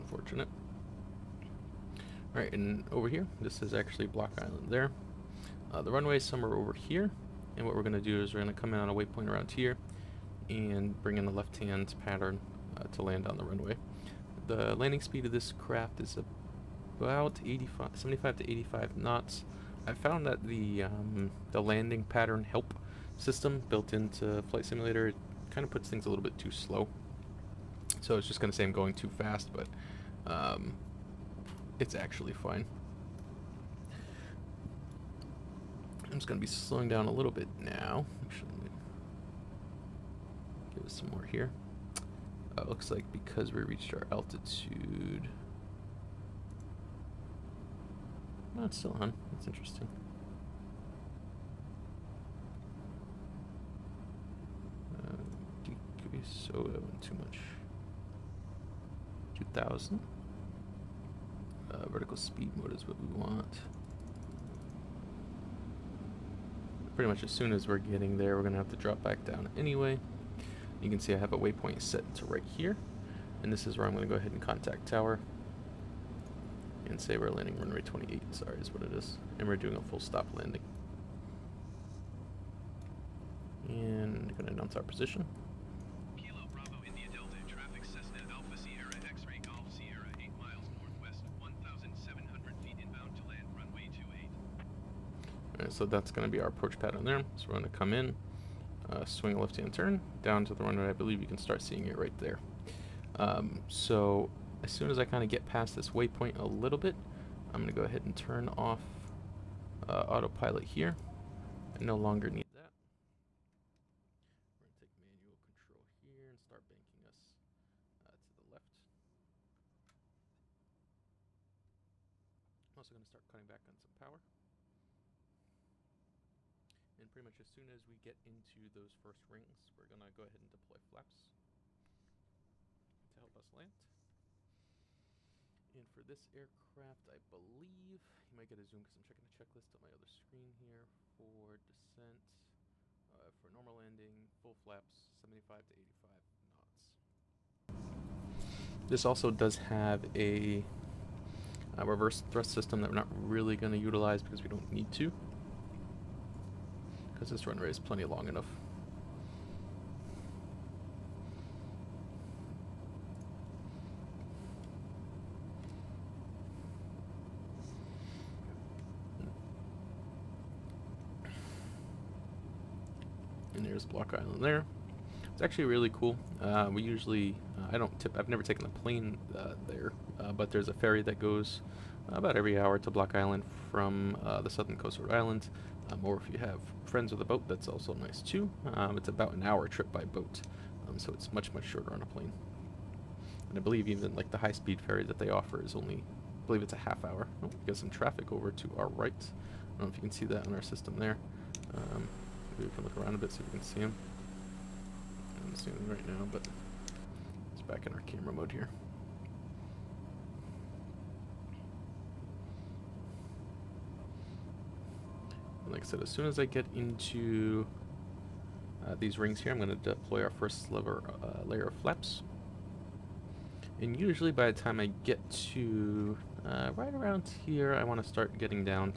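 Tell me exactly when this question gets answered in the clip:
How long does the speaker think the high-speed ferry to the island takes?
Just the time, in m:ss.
3:16.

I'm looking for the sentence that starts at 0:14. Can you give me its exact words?
The landing speed of this craft is about 85, 75 to 85 knots.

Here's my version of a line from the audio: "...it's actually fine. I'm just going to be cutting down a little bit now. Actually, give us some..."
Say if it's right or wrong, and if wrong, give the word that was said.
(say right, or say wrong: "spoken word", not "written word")
wrong: "slowing", not "cutting".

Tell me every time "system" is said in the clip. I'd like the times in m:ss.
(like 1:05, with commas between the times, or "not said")
0:23, 2:32, 3:20.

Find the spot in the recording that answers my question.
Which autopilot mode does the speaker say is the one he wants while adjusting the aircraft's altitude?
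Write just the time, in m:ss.
1:01.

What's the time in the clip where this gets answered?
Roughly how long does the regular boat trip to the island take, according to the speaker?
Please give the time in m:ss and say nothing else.
3:09.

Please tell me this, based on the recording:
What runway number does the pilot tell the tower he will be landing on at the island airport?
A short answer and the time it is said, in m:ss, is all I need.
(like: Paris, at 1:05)
28, at 1:17.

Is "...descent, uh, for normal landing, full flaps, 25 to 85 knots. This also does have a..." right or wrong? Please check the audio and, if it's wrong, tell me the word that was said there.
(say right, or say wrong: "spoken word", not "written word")
wrong: "75", not "25".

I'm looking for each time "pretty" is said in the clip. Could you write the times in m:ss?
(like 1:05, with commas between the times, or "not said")
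1:06, 2:07.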